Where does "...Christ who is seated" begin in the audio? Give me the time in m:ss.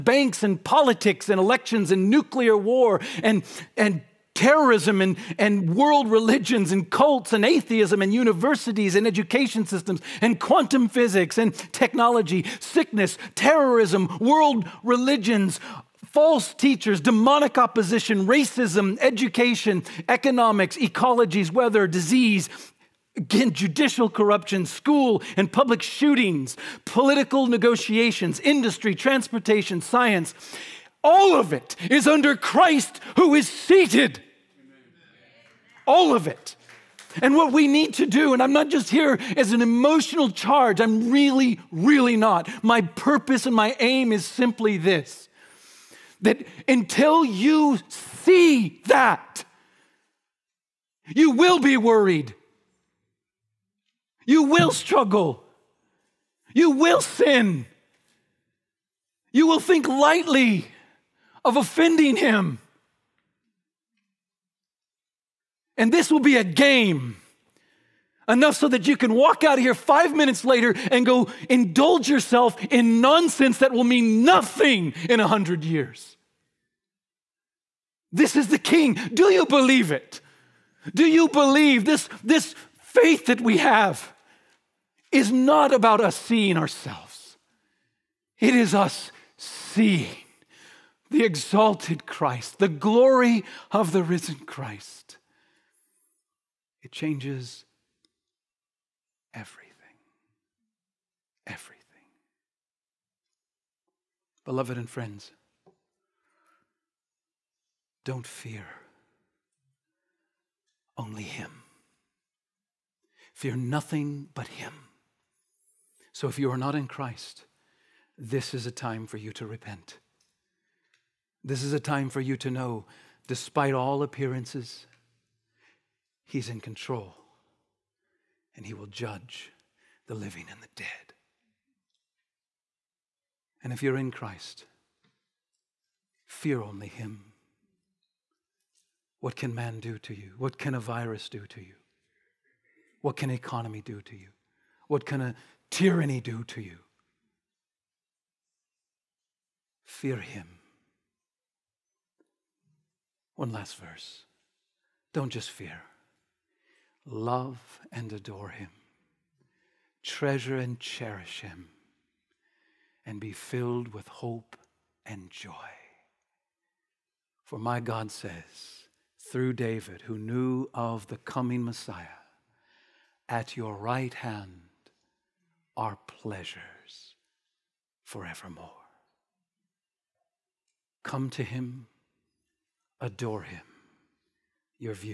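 0:32.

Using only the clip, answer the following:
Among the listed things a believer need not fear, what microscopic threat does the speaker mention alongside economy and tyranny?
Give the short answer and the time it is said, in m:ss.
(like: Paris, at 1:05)
A virus, at 2:20.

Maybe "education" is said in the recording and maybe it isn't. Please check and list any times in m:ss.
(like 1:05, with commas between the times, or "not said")
0:09, 0:18.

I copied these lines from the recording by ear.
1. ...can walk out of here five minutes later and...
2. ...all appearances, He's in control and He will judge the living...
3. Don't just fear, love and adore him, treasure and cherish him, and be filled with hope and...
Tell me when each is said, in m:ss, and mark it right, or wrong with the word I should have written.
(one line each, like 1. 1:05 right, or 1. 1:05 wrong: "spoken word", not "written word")
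1. 1:08 right
2. 2:03 right
3. 2:35 right.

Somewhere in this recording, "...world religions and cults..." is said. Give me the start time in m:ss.
0:05.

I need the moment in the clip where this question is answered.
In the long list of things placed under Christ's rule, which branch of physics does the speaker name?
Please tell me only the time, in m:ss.
0:10.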